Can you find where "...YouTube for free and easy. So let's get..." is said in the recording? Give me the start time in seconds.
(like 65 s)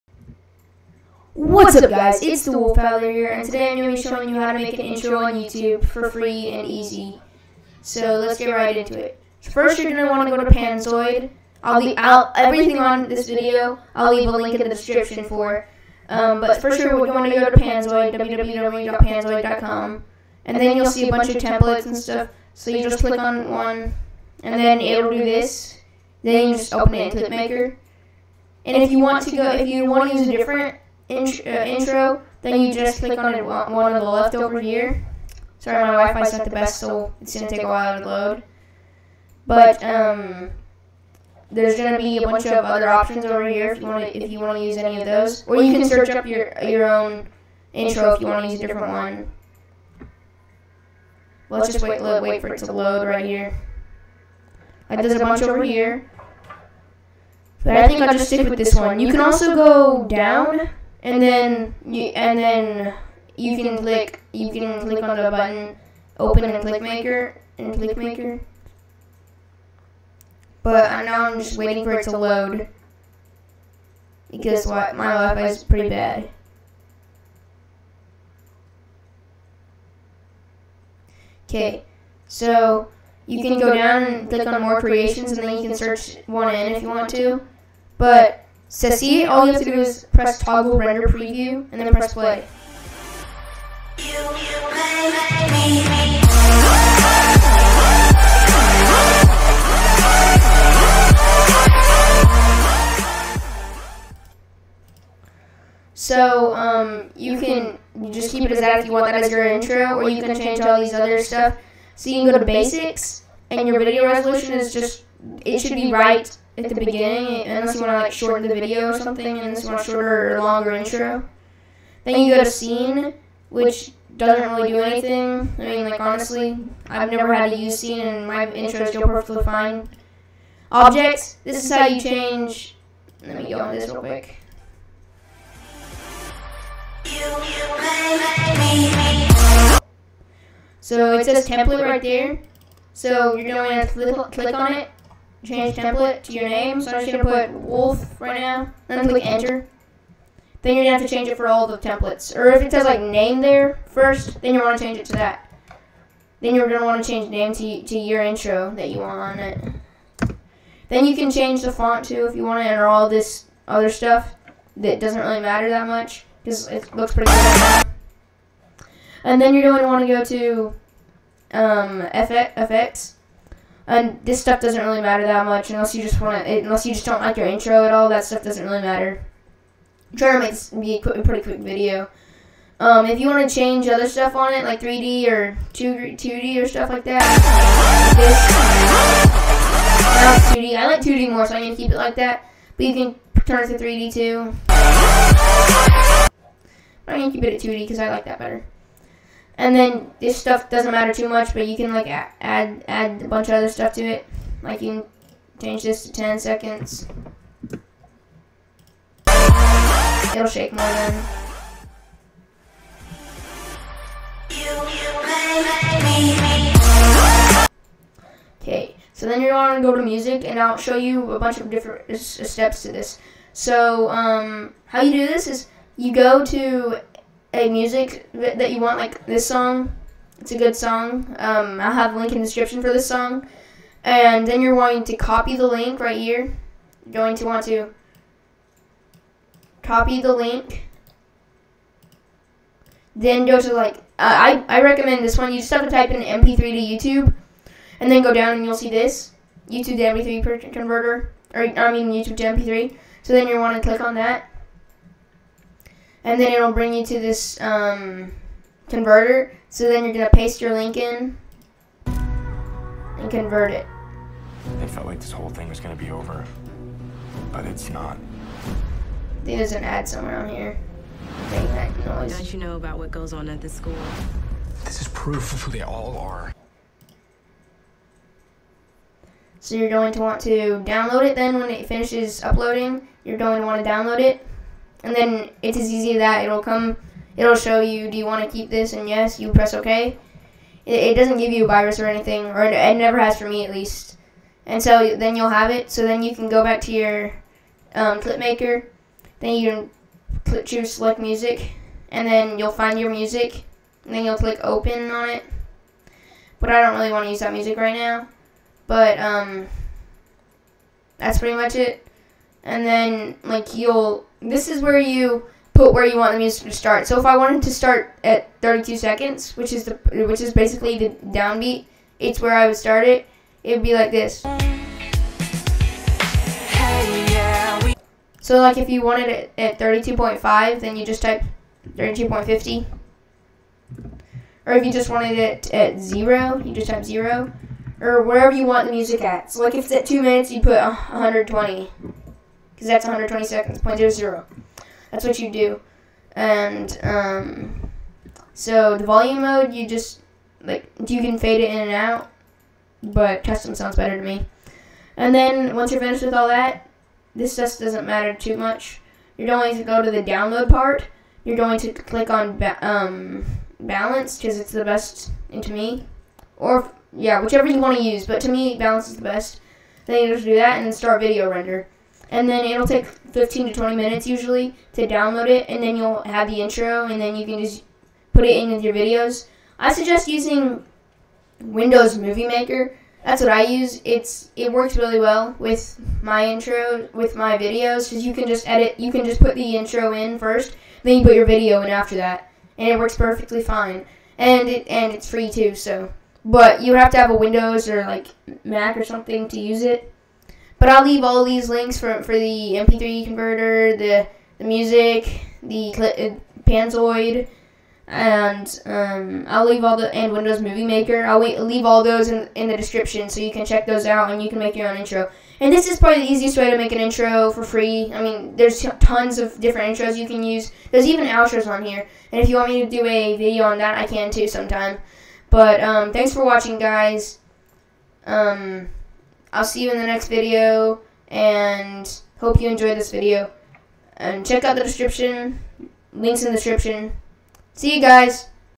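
5 s.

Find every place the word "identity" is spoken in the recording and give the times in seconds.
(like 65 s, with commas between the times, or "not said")
not said.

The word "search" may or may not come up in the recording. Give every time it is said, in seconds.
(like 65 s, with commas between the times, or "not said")
45 s, 85 s.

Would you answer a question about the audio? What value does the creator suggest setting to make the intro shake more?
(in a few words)
10 seconds.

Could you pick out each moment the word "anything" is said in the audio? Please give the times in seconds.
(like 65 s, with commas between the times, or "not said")
124 s, 292 s.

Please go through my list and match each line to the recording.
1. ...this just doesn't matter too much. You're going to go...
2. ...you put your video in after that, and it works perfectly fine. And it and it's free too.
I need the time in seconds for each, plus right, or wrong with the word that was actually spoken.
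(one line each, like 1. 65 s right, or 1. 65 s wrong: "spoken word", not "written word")
1. 357 s right
2. 391 s right.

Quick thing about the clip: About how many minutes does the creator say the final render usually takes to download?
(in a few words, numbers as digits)
15 to 20 minutes.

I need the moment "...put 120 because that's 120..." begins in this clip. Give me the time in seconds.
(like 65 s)
340 s.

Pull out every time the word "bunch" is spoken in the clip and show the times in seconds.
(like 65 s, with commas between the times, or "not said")
21 s, 42 s, 55 s, 203 s, 221 s.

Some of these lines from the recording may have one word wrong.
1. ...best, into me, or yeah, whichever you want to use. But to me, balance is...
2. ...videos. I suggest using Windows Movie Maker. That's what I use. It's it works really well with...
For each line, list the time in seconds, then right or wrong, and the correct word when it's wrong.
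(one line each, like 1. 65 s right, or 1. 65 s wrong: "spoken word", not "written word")
1. 364 s right
2. 378 s right.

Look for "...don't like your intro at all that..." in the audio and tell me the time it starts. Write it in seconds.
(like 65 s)
177 s.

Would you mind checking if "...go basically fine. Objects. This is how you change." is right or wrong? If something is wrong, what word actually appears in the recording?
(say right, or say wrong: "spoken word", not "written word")
wrong: "perfectly", not "basically".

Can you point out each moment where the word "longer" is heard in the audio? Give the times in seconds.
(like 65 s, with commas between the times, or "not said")
120 s.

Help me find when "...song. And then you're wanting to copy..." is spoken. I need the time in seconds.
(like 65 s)
233 s.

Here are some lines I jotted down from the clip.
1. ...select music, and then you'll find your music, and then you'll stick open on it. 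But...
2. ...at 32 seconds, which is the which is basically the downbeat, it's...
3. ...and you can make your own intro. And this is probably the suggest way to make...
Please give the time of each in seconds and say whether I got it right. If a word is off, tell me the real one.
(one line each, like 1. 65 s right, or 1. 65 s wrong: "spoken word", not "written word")
1. 300 s wrong: "click", not "stick"
2. 318 s right
3. 414 s wrong: "easiest", not "suggest".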